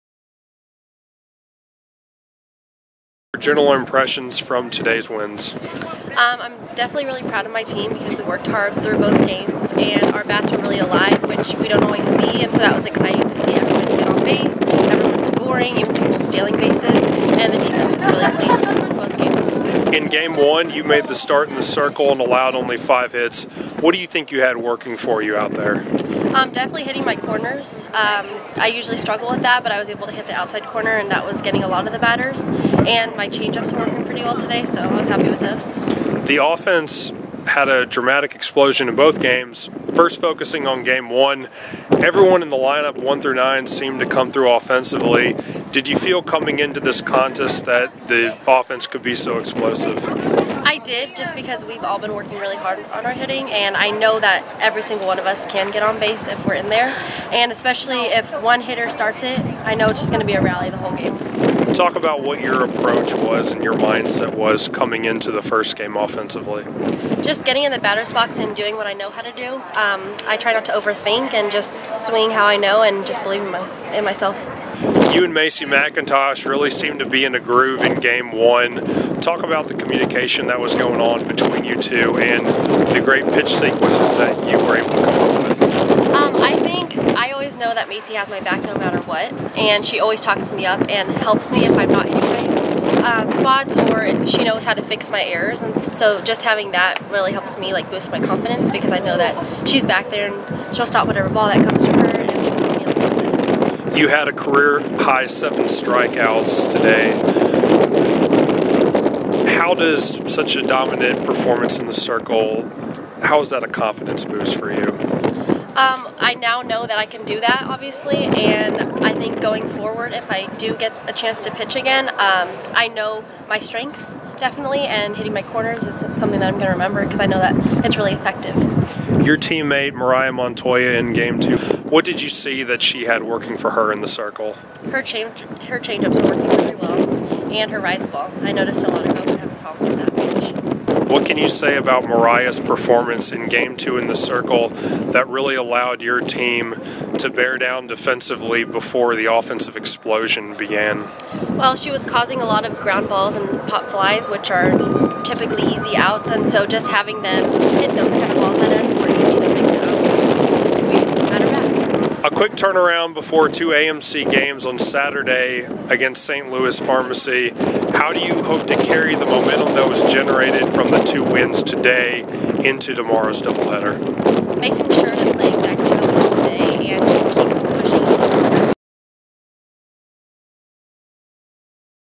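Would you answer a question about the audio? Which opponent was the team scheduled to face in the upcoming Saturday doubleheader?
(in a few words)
St. Louis Pharmacy.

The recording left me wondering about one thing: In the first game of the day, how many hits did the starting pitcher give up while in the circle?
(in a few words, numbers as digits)
5.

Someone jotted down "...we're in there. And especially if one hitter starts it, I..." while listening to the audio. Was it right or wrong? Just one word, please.
right.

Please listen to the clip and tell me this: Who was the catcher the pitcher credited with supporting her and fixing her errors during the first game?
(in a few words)
Macy McIntosh.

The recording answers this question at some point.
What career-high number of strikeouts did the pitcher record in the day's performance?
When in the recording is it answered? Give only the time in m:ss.
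1:45.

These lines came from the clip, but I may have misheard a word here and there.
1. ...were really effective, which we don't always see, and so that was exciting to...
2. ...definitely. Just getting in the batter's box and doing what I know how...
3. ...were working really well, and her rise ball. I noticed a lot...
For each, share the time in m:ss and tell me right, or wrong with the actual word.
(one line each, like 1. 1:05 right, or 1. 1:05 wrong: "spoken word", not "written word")
1. 0:10 wrong: "alive", not "effective"
2. 1:05 wrong: "offensively", not "definitely"
3. 2:16 right.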